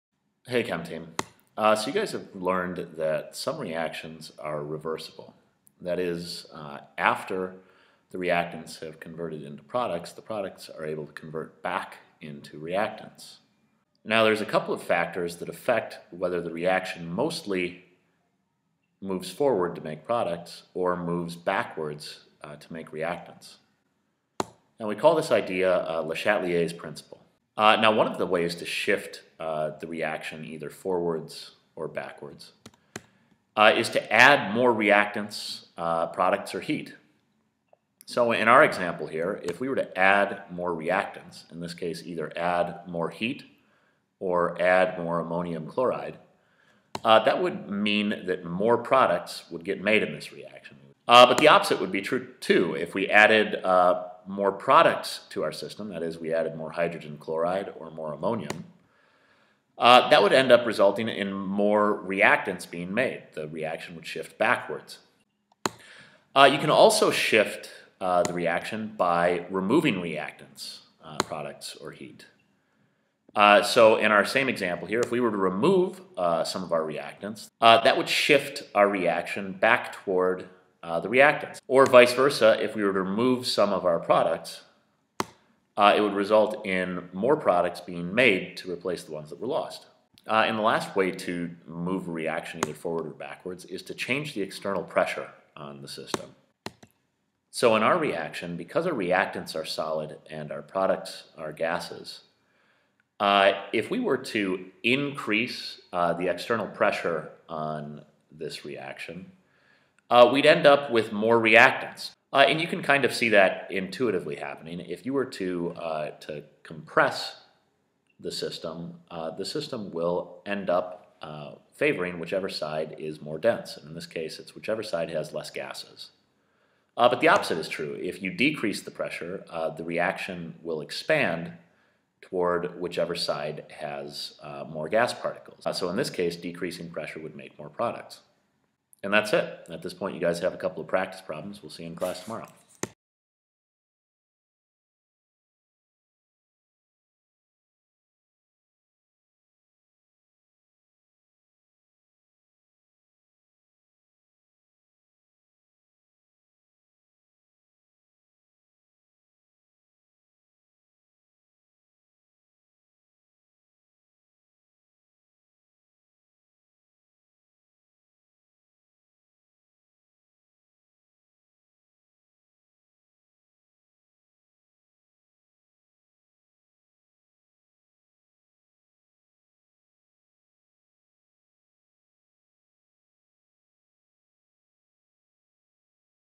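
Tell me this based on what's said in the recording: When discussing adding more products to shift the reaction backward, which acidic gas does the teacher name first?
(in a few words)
Hydrogen chloride.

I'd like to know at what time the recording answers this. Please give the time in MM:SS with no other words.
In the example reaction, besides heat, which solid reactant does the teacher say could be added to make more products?
00:45.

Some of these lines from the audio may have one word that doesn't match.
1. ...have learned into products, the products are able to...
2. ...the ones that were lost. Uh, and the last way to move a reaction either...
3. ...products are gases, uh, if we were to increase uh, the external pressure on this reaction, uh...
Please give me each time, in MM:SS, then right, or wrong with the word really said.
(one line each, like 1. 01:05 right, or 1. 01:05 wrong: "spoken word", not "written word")
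1. 00:08 wrong: "converted", not "learned"
2. 01:29 right
3. 01:40 right.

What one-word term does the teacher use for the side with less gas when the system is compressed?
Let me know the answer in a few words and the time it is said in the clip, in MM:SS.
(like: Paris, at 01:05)
Dense, at 02:03.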